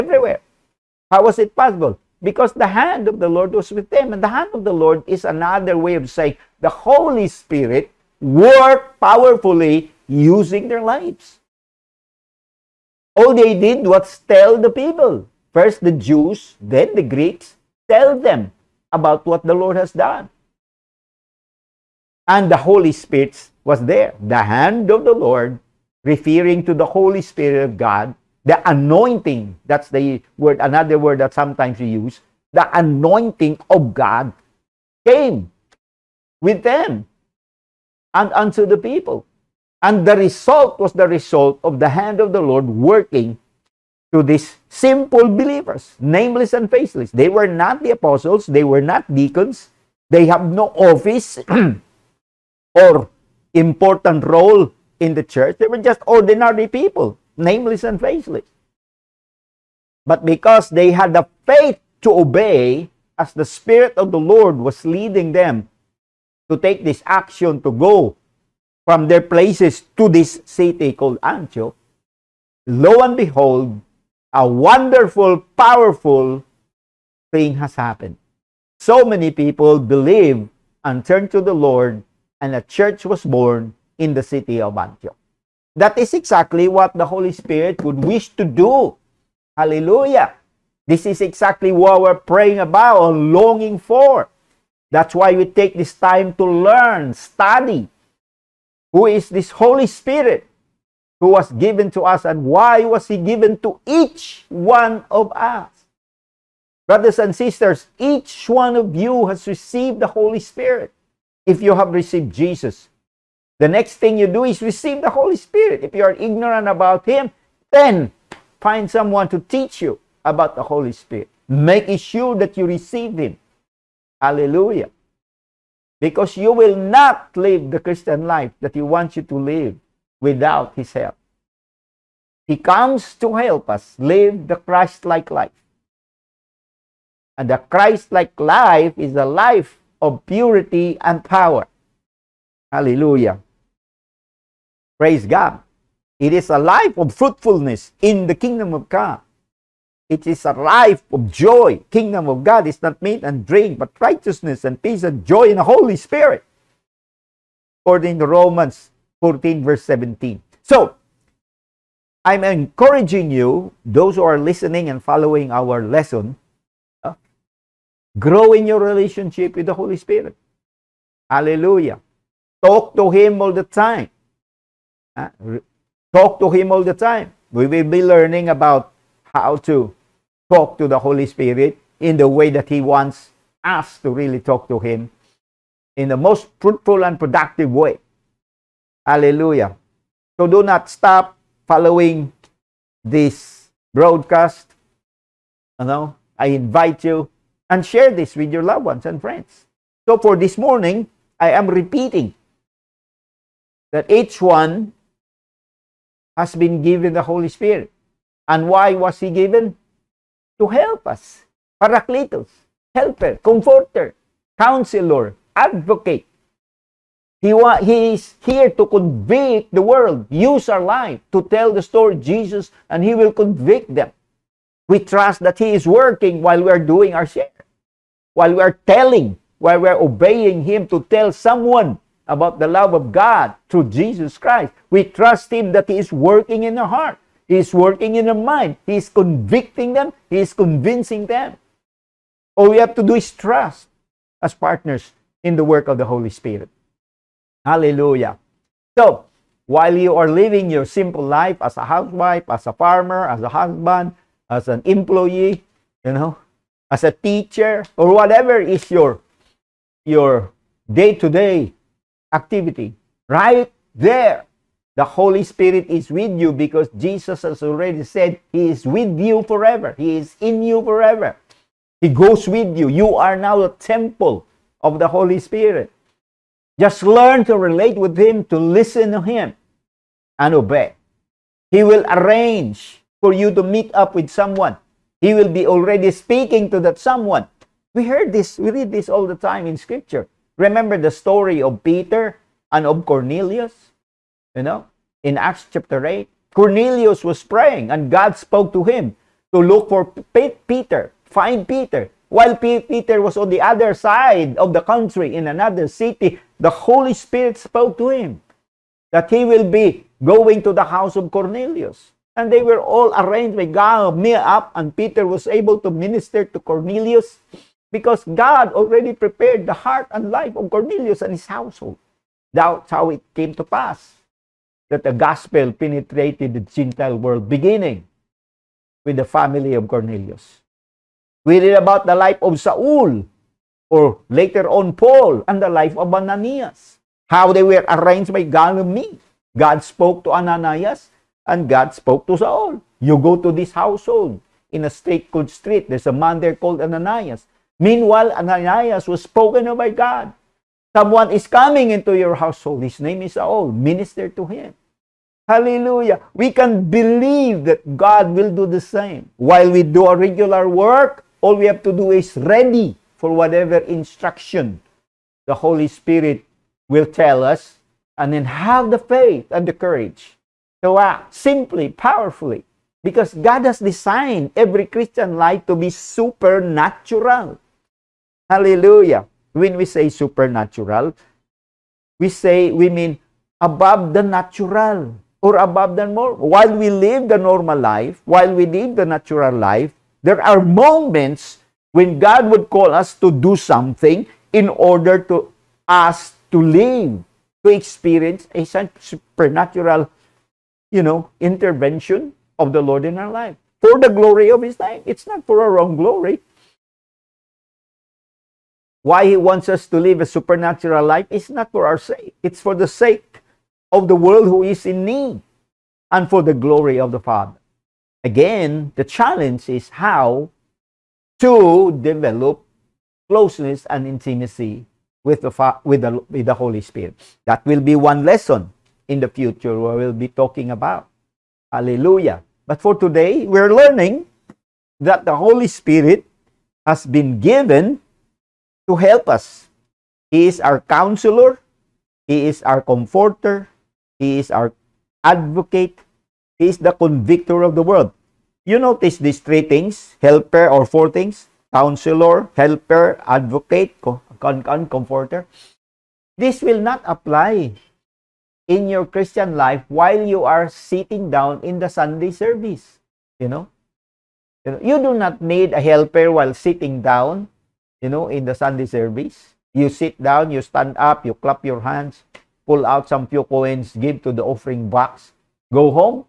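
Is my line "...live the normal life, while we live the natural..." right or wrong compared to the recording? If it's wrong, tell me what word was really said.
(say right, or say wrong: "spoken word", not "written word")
right.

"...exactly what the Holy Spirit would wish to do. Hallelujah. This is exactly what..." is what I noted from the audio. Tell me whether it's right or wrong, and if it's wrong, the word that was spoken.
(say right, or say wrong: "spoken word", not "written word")
right.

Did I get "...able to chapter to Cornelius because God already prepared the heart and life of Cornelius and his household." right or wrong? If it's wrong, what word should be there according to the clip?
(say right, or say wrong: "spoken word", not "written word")
wrong: "minister", not "chapter".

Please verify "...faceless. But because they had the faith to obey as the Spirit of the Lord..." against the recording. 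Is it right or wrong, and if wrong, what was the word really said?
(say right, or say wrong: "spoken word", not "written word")
right.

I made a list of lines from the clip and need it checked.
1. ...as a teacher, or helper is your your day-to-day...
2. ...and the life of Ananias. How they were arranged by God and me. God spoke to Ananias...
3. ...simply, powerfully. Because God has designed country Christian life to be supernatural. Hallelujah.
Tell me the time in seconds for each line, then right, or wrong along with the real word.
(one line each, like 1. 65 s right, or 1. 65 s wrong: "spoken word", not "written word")
1. 256 s wrong: "whatever", not "helper"
2. 335 s right
3. 371 s wrong: "every", not "country".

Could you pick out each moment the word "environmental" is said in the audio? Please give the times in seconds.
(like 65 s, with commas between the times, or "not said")
not said.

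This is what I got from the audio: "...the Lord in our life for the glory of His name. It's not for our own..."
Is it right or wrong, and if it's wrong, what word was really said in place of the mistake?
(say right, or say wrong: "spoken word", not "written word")
right.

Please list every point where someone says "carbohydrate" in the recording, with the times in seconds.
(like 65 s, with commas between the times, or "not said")
not said.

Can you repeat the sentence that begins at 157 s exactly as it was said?
According to Romans 14, verse 17.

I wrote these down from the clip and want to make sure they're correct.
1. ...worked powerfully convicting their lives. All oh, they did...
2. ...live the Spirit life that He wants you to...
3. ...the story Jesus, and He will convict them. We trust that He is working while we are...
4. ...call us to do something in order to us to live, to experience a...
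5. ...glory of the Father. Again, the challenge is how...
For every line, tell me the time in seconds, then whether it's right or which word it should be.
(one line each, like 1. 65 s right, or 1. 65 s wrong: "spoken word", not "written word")
1. 8 s wrong: "using", not "convicting"
2. 127 s wrong: "Christian", not "Spirit"
3. 221 s right
4. 392 s right
5. 416 s right.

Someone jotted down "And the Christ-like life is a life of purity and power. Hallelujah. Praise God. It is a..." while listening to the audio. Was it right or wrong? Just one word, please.
right.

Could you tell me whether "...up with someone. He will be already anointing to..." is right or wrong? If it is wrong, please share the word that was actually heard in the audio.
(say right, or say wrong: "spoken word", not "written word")
wrong: "speaking", not "anointing".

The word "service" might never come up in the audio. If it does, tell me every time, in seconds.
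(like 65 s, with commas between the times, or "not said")
462 s, 468 s.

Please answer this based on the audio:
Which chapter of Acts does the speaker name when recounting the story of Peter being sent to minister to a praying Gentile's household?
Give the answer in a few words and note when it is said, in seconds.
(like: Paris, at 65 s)
Acts 8, at 295 s.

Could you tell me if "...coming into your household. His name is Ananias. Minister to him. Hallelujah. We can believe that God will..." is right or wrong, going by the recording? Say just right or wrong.
wrong.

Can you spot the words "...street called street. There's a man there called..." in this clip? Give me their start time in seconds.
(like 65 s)
344 s.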